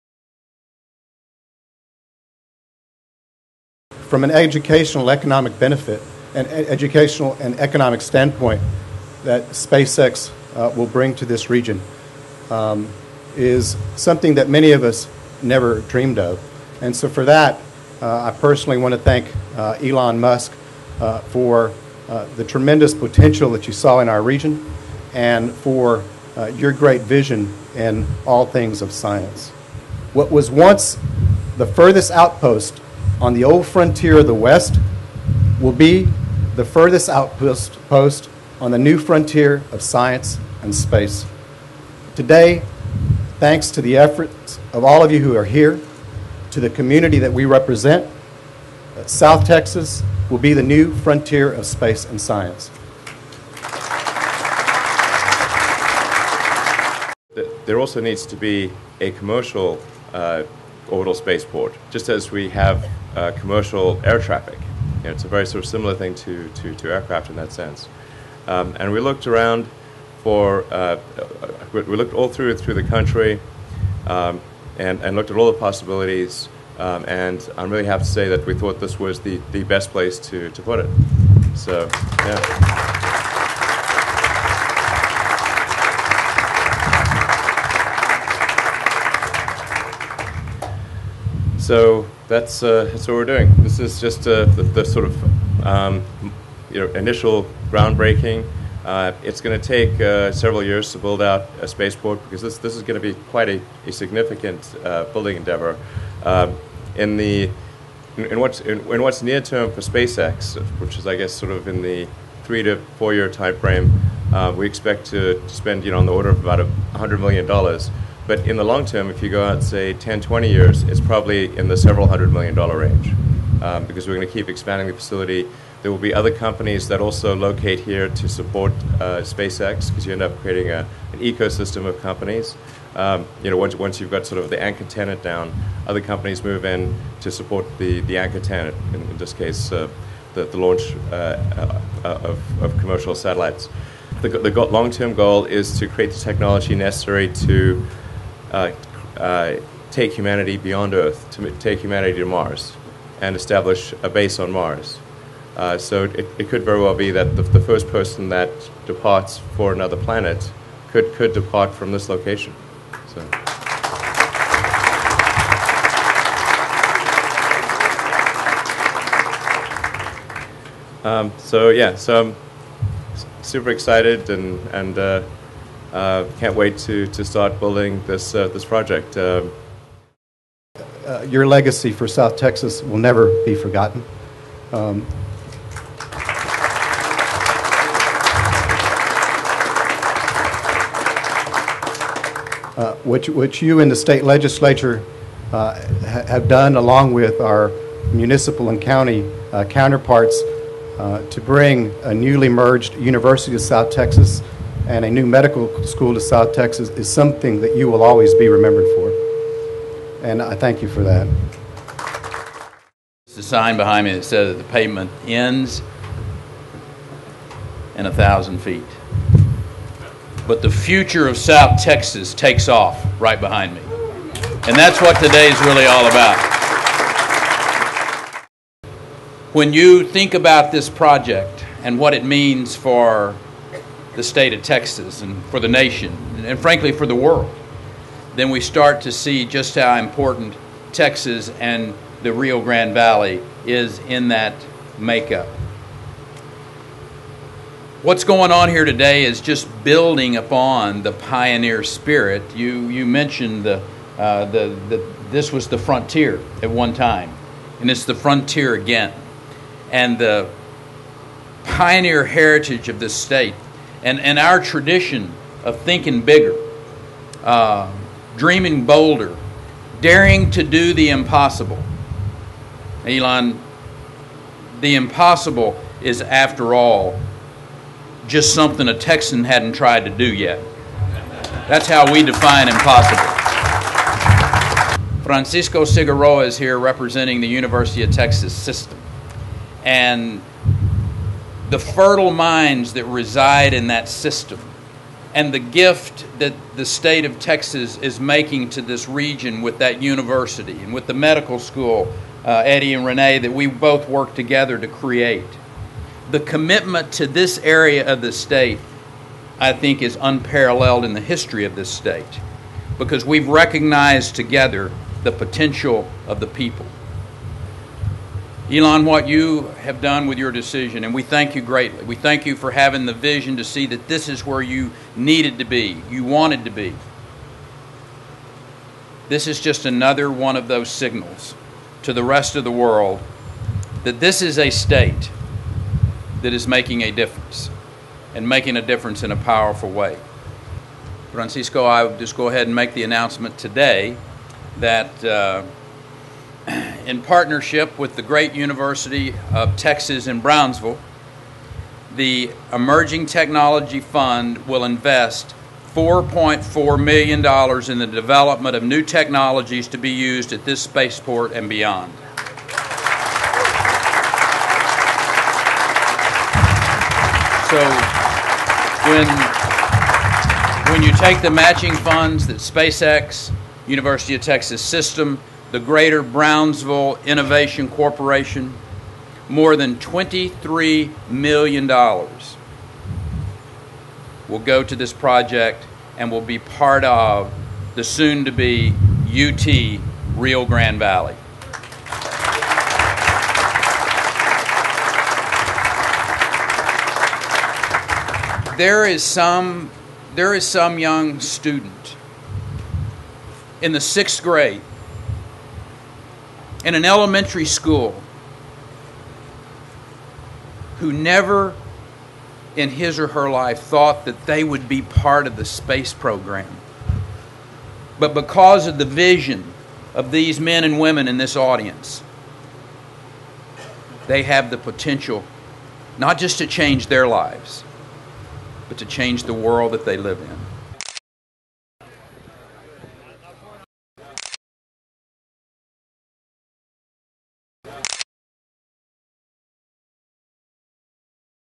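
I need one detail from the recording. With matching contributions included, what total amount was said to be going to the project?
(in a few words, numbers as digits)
more than $23 million.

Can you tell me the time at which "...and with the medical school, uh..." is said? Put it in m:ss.
5:00.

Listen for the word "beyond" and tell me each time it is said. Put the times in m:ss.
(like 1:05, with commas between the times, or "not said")
2:30, 6:01.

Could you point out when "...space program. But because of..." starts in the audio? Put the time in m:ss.
6:55.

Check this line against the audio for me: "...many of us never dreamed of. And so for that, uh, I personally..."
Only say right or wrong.
right.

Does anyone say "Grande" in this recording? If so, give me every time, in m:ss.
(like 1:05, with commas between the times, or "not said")
4:02, 6:30.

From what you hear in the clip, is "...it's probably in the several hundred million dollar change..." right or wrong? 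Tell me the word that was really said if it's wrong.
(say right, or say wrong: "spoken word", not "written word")
wrong: "range", not "change".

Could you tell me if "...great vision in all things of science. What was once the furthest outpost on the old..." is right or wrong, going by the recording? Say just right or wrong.
right.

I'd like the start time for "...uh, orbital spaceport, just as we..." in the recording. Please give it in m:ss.
1:00.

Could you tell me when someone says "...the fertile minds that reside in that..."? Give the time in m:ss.
4:51.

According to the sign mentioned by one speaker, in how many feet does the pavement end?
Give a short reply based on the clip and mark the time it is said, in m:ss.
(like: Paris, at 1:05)
1,000 feet, at 3:38.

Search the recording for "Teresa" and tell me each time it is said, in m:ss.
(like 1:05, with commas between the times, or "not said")
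not said.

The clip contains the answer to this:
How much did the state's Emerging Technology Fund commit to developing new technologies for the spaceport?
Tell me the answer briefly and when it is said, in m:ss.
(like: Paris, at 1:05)
$4.4 million, at 5:55.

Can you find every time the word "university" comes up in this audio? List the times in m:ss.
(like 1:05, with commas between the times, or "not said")
3:22, 4:47, 5:00, 5:48, 6:13.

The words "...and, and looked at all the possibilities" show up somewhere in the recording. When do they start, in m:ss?
1:14.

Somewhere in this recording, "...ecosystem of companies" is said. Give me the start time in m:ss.
2:11.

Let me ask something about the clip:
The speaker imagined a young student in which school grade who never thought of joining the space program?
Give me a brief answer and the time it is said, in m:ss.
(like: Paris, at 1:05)
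6th grade, at 6:43.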